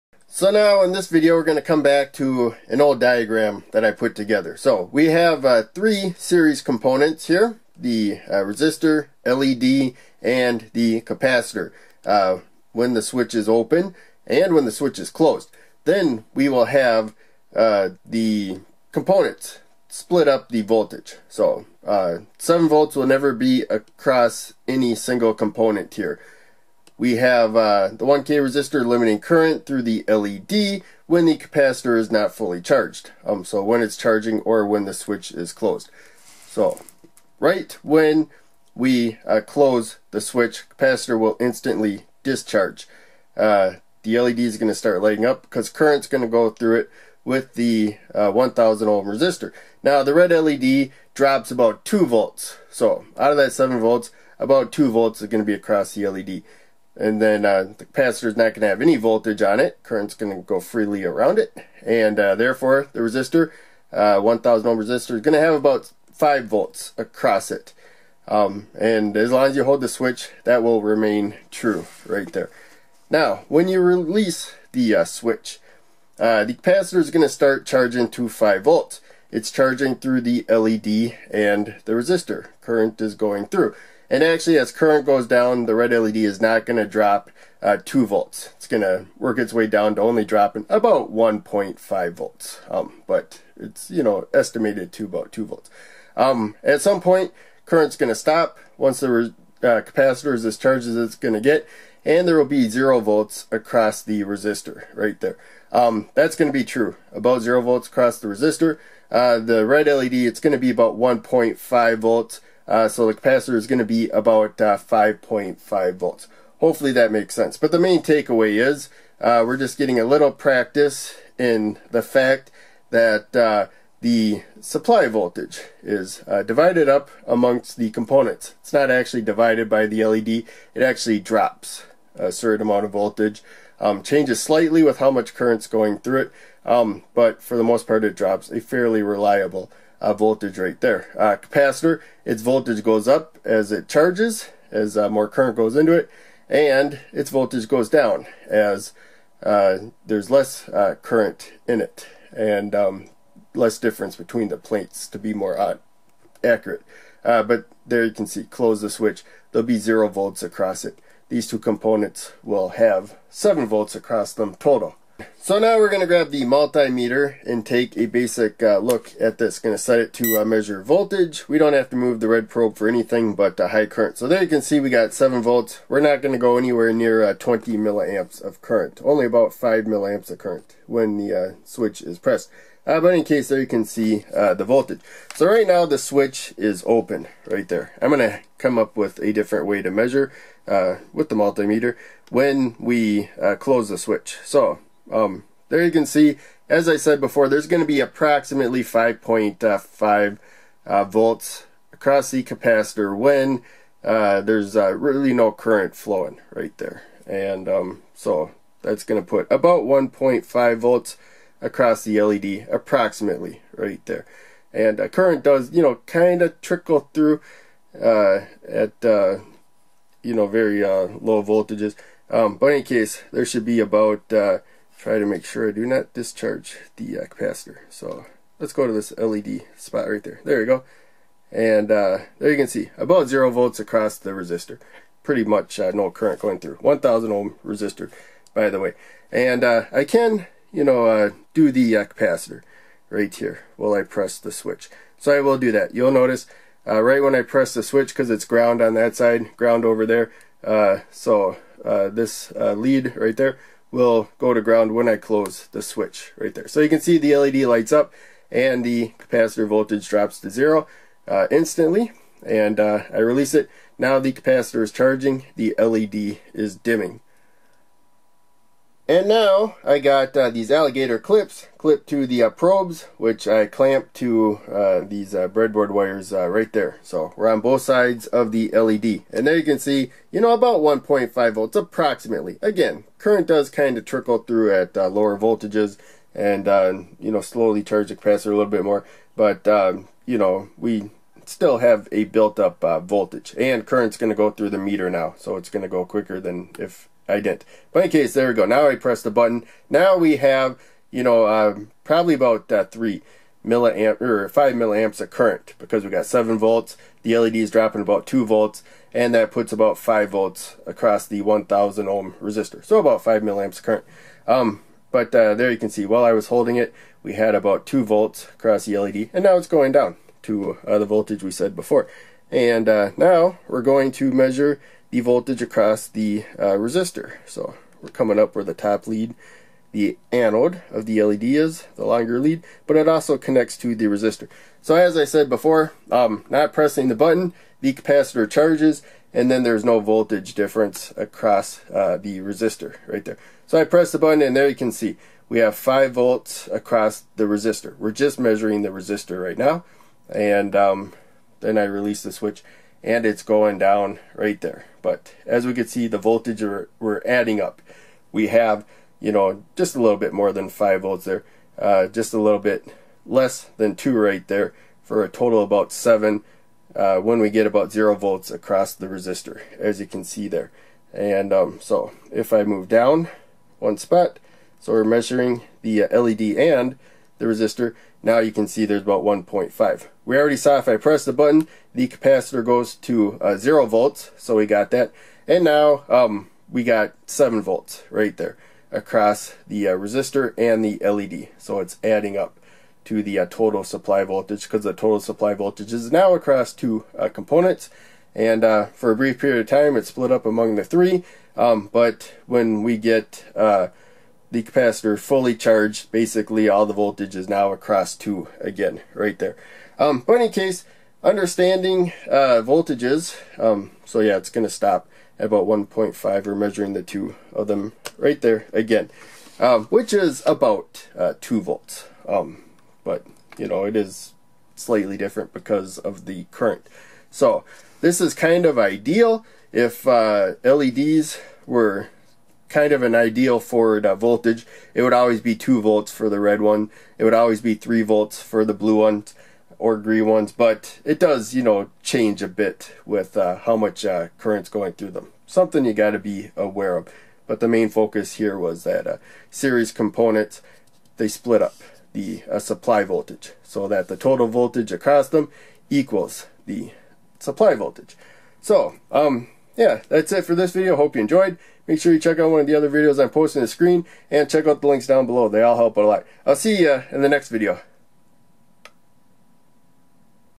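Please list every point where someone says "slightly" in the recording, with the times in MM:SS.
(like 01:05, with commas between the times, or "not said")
02:14, 07:04.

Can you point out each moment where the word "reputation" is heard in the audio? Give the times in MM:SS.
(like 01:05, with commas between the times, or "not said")
not said.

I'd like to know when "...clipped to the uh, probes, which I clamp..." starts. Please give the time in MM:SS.
04:31.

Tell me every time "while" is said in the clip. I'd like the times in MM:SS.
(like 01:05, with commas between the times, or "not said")
04:03, 05:16.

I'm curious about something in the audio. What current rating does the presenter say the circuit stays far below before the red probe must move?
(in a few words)
20 milliamps.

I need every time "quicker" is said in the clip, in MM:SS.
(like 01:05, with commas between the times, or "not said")
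04:56.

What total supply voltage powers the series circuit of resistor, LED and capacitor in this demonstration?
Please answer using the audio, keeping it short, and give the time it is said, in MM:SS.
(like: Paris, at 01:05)
7 volts, at 00:22.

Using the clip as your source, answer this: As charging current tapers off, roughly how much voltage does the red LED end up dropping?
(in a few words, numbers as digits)
1.5 volts.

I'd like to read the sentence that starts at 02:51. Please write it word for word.
We don't have to move the red probe for anything but uh, high current.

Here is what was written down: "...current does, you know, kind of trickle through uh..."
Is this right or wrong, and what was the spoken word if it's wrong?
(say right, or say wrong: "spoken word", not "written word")
right.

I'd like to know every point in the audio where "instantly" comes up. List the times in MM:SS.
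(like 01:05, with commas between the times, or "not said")
00:41, 04:21.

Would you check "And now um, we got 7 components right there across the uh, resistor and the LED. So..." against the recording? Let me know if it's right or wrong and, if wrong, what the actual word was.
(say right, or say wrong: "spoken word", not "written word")
wrong: "volts", not "components".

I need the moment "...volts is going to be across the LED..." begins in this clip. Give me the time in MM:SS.
00:54.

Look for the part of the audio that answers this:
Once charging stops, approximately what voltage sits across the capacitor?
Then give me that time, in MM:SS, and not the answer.
01:53.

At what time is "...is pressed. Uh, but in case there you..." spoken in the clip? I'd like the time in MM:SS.
03:02.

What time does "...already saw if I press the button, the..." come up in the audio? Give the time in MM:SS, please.
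06:20.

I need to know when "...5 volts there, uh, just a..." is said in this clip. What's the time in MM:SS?
06:00.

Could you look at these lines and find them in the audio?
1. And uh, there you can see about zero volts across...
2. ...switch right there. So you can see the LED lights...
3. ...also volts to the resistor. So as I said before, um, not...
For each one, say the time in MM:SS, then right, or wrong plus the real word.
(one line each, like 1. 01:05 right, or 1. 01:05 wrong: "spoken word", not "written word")
1. 03:51 right
2. 04:15 right
3. 05:33 wrong: "connects", not "volts".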